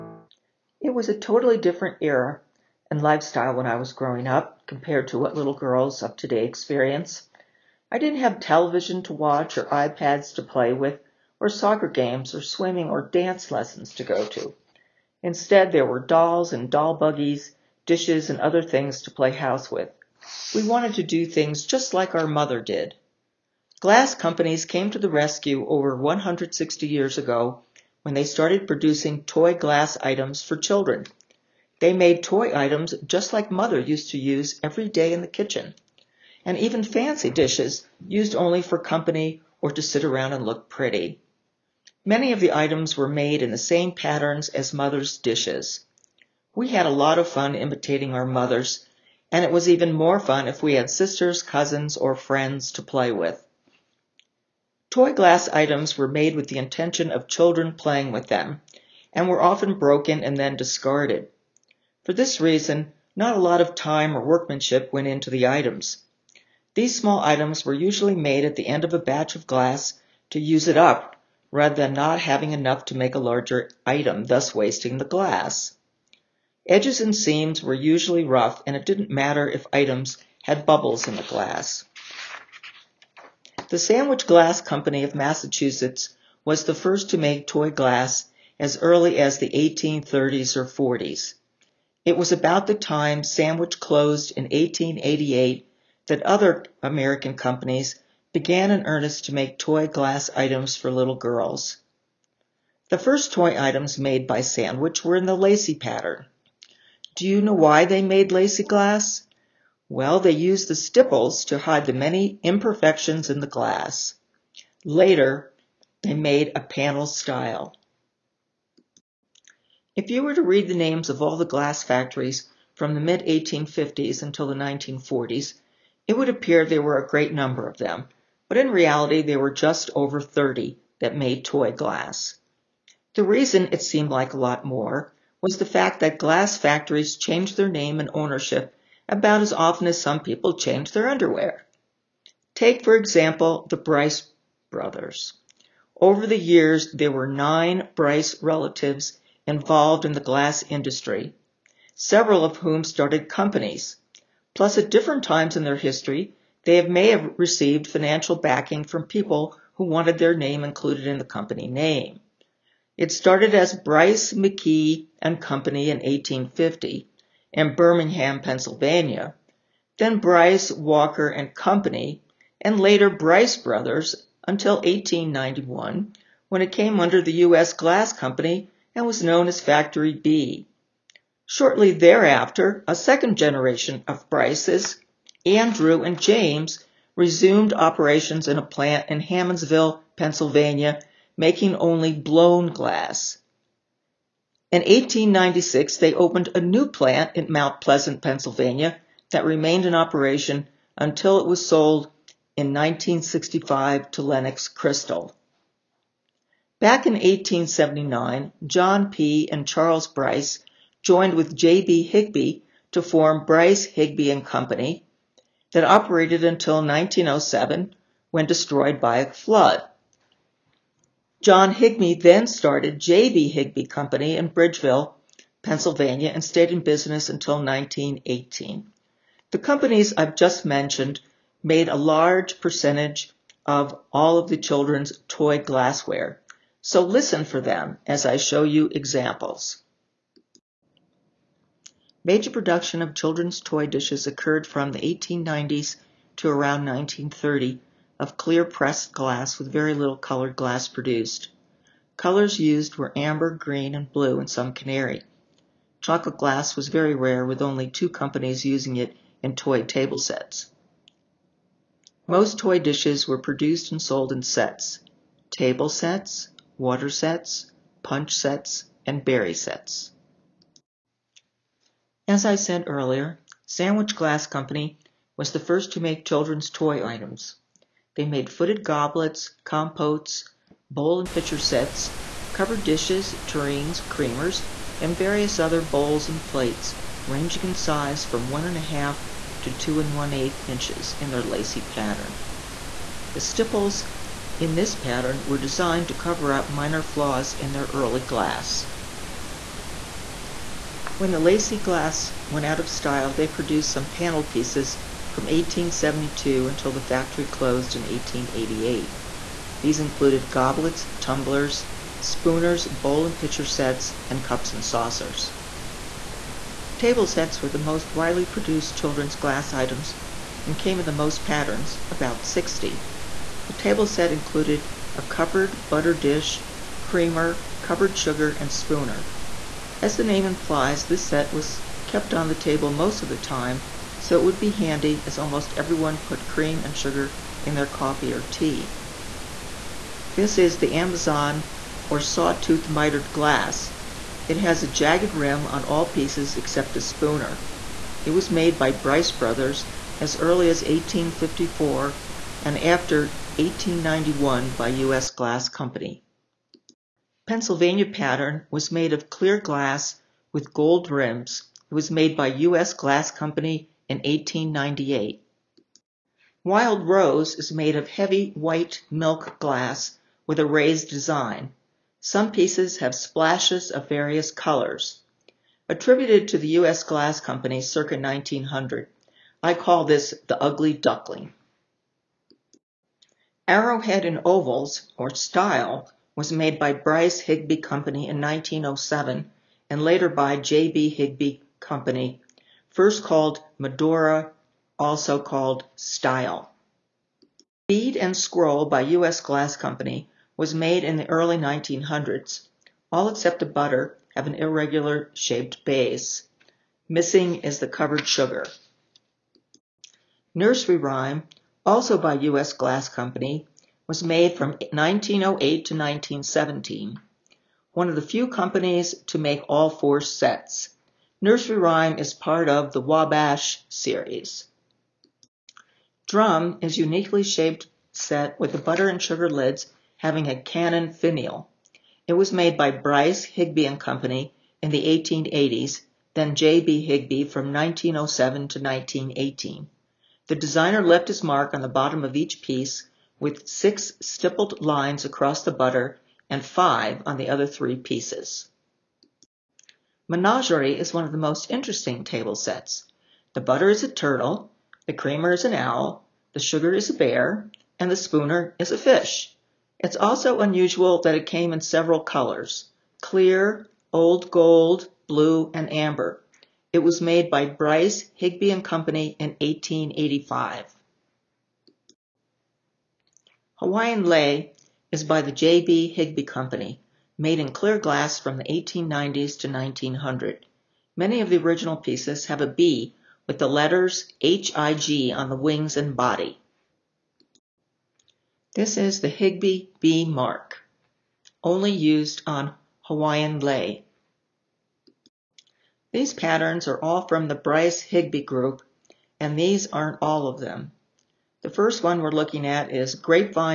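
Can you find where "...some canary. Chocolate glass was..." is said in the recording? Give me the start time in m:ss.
4:14.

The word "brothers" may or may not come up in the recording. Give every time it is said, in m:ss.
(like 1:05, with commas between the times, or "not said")
2:24, 2:53, 5:49.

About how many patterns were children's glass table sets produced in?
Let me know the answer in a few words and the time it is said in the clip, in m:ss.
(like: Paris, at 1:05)
about 60, at 5:22.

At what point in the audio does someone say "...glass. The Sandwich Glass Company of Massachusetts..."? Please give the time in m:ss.
1:21.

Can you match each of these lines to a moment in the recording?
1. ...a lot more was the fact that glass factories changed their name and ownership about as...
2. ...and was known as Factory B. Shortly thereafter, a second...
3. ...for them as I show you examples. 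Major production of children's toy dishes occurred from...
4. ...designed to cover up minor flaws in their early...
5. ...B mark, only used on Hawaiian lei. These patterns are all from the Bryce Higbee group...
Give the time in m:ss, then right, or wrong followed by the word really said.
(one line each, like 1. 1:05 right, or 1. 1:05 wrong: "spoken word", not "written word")
1. 2:14 right
2. 2:58 right
3. 3:57 right
4. 4:55 right
5. 8:09 right.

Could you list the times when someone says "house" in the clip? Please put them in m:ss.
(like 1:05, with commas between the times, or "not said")
0:19.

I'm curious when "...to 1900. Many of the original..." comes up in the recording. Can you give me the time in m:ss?
7:59.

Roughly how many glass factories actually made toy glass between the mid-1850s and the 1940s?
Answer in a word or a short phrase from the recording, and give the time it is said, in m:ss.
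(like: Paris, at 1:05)
just over 30, at 2:09.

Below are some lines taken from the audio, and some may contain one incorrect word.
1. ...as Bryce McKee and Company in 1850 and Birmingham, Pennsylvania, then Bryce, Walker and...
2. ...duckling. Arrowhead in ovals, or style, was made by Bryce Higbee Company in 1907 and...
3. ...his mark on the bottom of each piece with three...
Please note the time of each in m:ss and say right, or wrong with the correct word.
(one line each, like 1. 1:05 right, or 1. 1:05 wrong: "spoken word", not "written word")
1. 2:43 right
2. 6:20 right
3. 7:21 wrong: "six", not "three".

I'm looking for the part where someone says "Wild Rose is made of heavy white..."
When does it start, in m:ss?
6:06.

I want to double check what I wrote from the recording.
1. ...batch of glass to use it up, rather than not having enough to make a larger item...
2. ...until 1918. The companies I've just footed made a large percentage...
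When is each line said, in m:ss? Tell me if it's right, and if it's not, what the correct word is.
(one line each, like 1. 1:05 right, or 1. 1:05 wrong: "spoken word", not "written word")
1. 1:08 right
2. 3:47 wrong: "mentioned", not "footed".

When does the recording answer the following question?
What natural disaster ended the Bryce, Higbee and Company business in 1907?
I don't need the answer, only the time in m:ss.
3:39.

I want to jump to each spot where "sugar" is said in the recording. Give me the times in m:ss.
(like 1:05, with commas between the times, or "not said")
5:28, 5:36, 6:48, 7:09, 7:36.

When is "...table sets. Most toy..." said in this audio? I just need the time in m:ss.
4:19.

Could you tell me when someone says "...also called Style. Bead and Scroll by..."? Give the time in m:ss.
6:34.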